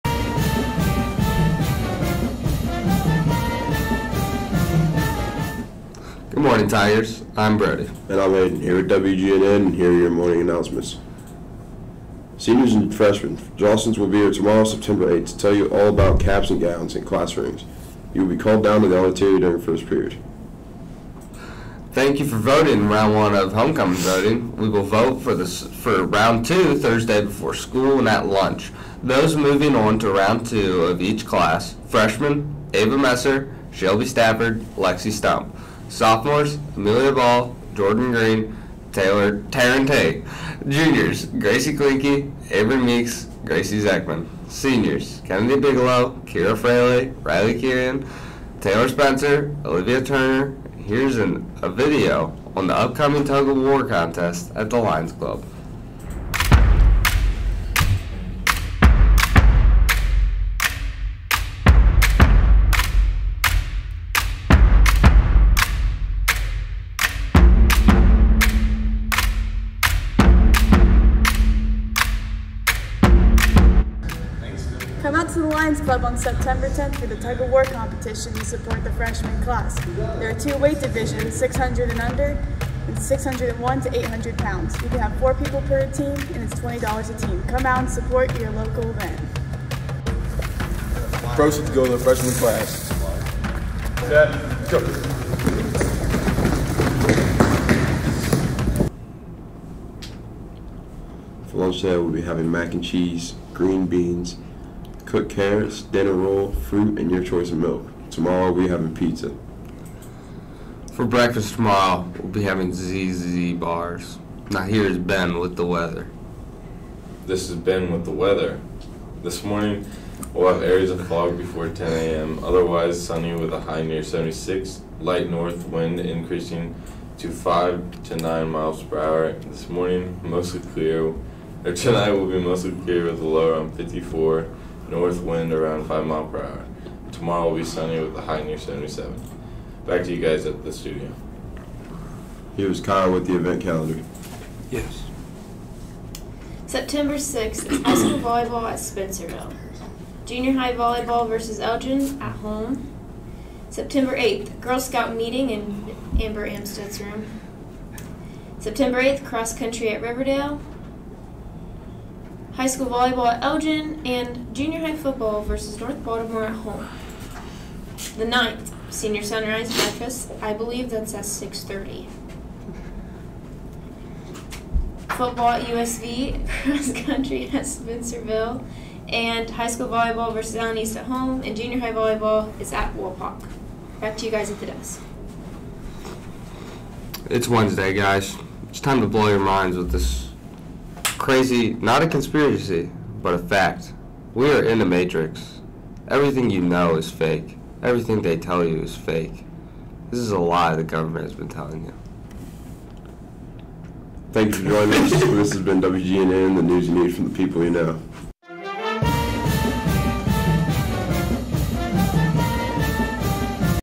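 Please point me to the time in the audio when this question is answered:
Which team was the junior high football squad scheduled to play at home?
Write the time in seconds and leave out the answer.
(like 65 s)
165 s.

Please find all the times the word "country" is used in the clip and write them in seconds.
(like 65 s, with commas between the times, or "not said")
159 s, 177 s.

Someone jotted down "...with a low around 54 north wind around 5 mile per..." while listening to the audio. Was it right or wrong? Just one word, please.
right.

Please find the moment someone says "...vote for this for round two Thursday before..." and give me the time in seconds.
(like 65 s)
24 s.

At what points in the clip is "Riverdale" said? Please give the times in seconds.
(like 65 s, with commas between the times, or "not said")
160 s.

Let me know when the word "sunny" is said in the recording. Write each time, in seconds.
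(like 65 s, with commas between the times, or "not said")
123 s, 137 s.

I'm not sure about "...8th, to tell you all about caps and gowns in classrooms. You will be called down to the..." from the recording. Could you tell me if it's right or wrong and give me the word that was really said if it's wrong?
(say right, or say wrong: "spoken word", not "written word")
right.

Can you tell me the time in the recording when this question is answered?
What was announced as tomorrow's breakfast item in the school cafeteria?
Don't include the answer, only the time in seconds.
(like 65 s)
112 s.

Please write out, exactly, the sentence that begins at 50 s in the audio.
Here's an, a video on the upcoming Tug of War contest at the Lions Club.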